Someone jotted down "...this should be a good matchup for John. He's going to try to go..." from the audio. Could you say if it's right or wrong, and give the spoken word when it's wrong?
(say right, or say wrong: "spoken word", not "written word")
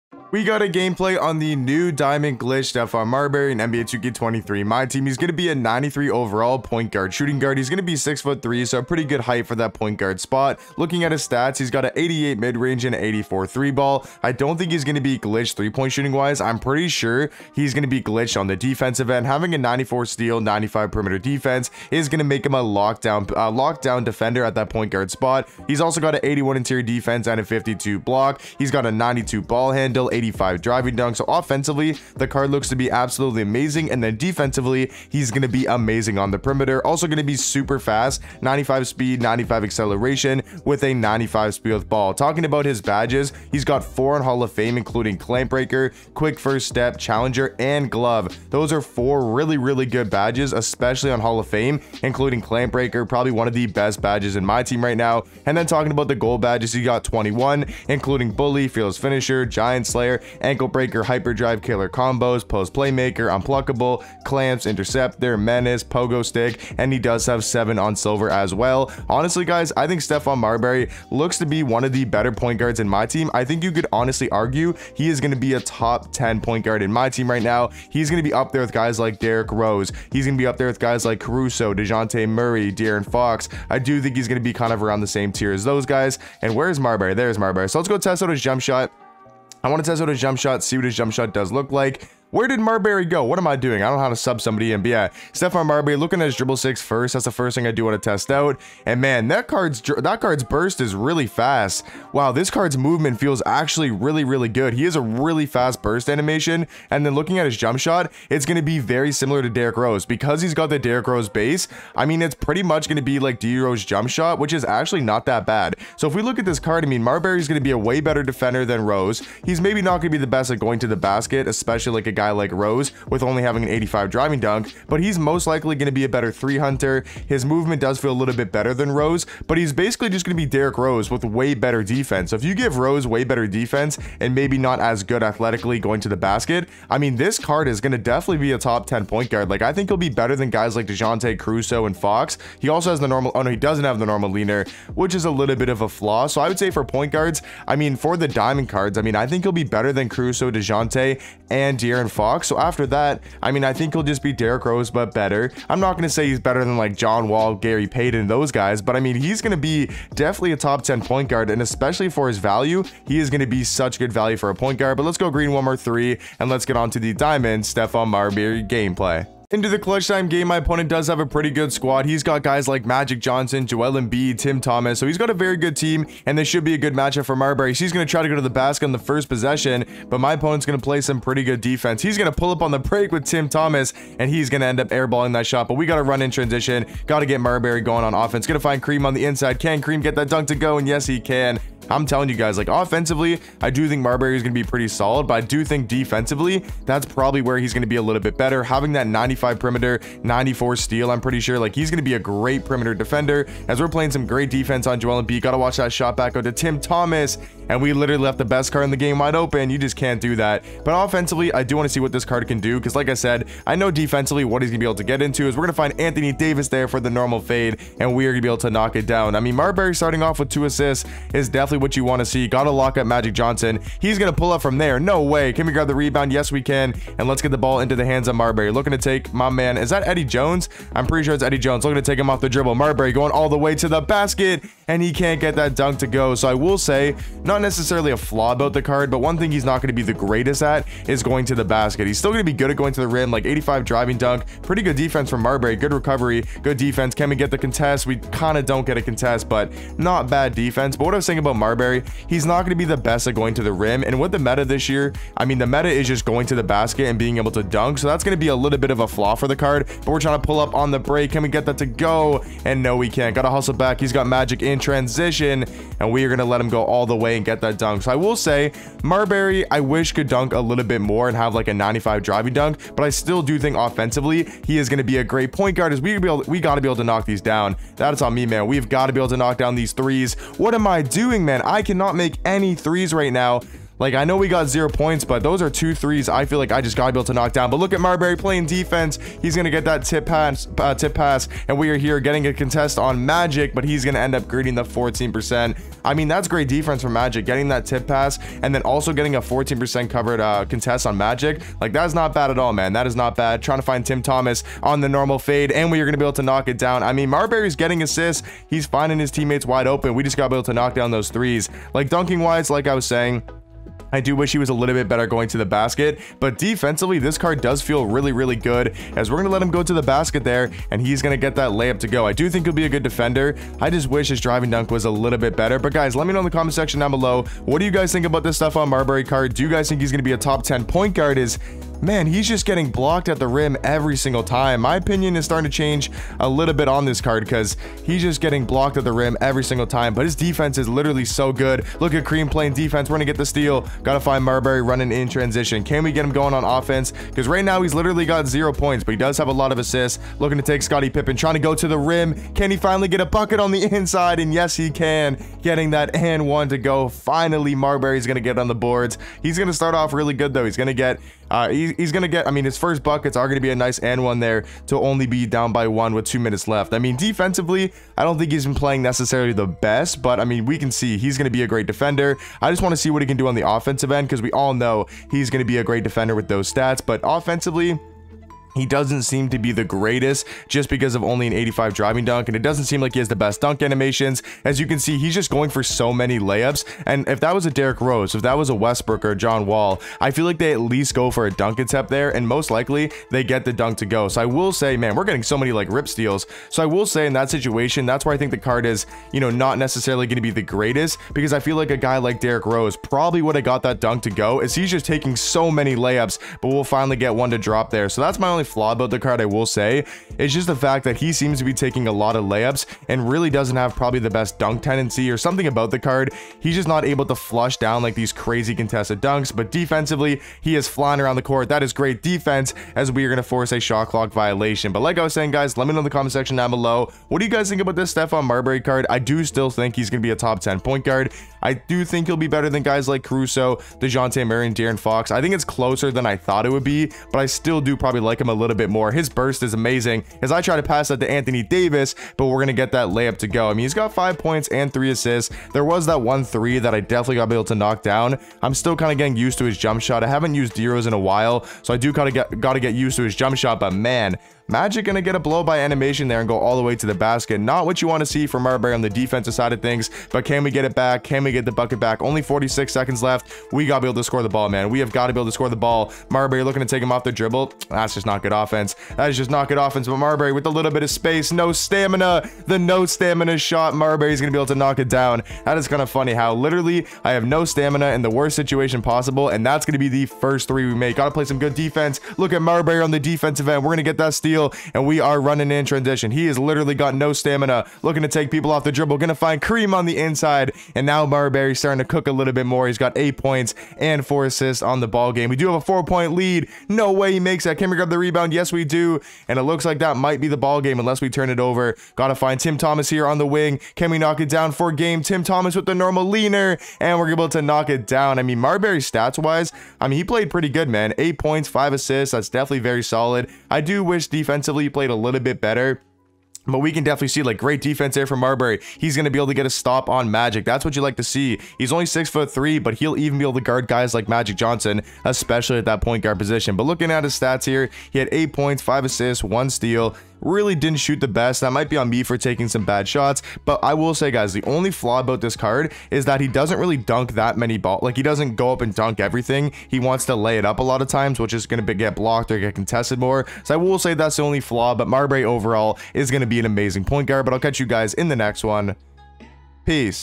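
wrong: "Marbury", not "John".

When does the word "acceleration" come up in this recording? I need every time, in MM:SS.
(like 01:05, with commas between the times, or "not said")
00:39.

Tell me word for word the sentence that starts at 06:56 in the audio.
He's just not able to flush down like these crazy contested dunks, but defensively, he is flying around the court.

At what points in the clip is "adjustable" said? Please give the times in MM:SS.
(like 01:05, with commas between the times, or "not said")
not said.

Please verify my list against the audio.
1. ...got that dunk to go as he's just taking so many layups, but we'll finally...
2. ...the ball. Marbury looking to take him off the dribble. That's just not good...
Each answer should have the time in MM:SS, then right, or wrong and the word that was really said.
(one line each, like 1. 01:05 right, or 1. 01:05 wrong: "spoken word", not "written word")
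1. 06:43 right
2. 07:45 right.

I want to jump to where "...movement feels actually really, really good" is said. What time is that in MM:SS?
01:42.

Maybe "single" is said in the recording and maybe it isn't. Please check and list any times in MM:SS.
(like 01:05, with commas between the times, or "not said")
05:34, 05:39.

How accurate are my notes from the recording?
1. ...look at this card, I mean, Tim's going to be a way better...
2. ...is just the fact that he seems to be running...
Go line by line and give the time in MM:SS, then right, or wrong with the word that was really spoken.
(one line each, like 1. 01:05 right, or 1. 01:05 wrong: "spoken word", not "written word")
1. 01:56 wrong: "Marbury", not "Tim"
2. 06:50 wrong: "taking", not "running".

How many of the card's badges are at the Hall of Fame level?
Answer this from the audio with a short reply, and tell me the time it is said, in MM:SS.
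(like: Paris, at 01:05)
4, at 00:43.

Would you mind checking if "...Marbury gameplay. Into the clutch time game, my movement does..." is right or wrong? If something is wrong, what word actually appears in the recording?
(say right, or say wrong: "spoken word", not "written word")
wrong: "opponent", not "movement".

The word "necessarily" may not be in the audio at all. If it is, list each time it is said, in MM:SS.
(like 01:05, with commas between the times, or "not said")
03:57, 06:09, 06:39.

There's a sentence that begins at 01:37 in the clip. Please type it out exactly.
That's the first thing I do want to test out.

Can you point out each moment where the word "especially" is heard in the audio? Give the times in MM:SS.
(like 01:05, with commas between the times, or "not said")
00:50, 02:01, 02:41, 08:45.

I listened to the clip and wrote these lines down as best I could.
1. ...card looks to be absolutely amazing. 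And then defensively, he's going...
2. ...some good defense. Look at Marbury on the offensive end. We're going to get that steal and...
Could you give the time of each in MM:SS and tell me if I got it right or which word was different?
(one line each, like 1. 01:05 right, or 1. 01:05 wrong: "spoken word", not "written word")
1. 00:32 right
2. 08:01 wrong: "defensive", not "offensive".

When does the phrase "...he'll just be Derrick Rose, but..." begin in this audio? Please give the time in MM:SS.
02:33.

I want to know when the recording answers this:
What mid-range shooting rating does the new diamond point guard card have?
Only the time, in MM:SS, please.
00:11.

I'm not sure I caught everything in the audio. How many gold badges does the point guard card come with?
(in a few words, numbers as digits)
21.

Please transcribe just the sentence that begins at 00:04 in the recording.
My team, he's going to be a 93 overall point guard, shooting guard.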